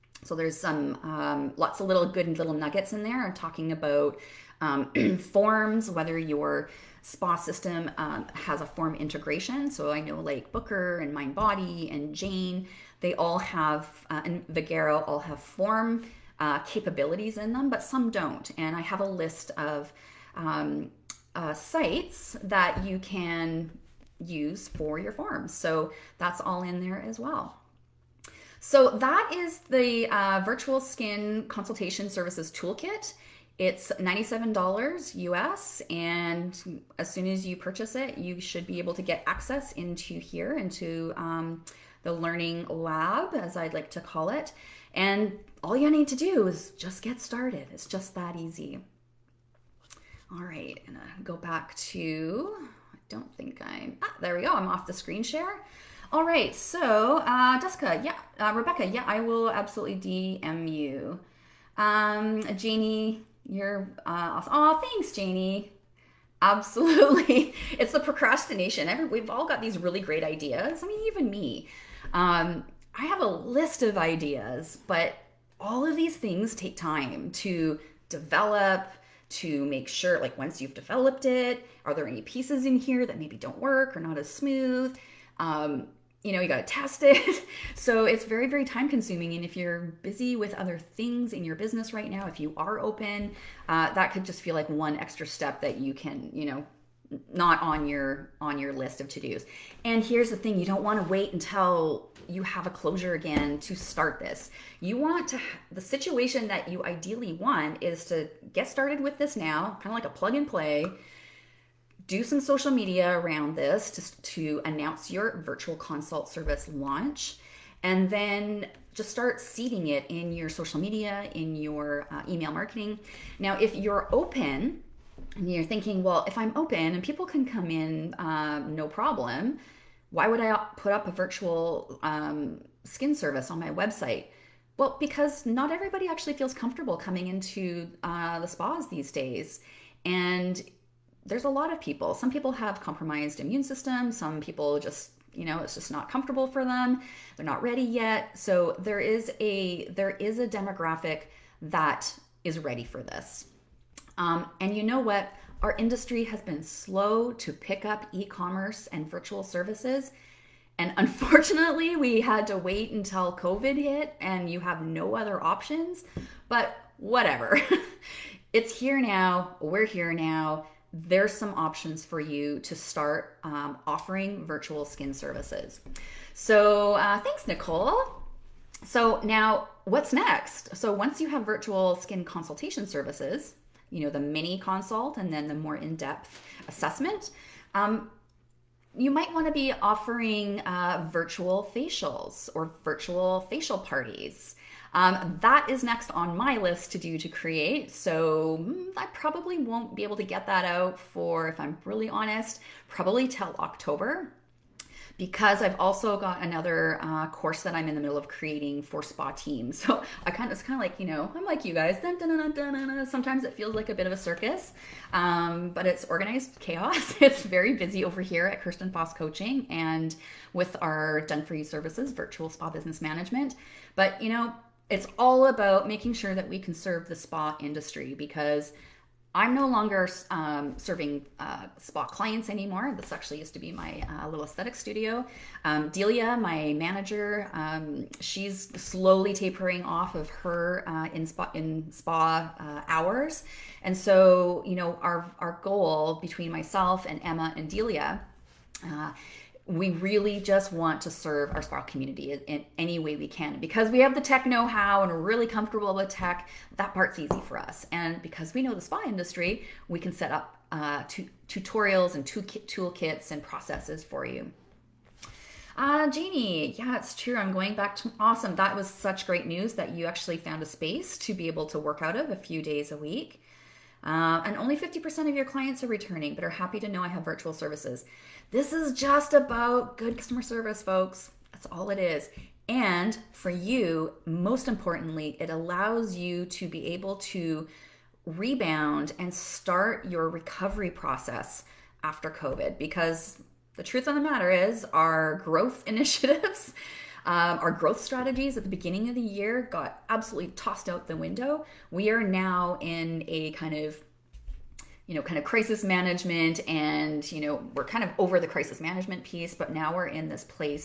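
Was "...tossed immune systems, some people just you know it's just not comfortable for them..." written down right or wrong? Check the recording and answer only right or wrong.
wrong.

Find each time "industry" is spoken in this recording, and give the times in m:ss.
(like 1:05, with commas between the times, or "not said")
2:35, 3:47, 4:19.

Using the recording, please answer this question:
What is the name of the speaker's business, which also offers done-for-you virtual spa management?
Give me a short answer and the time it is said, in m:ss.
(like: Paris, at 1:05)
Kirsten Foss Coaching, at 3:38.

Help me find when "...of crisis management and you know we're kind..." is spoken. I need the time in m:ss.
5:05.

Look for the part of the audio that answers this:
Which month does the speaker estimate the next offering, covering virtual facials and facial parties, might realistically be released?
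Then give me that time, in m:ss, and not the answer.
3:23.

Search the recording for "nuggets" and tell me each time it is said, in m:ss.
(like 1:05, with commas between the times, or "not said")
0:02.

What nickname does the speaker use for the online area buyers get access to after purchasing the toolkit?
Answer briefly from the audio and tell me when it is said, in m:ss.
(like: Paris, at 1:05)
the learning lab, at 0:42.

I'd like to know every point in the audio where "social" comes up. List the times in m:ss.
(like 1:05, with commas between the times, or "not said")
1:52, 2:00.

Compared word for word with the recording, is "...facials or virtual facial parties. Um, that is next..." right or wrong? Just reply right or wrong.
right.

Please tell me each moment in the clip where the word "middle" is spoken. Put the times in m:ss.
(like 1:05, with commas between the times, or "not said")
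3:28.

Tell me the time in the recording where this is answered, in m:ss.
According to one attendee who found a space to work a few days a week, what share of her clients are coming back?
4:34.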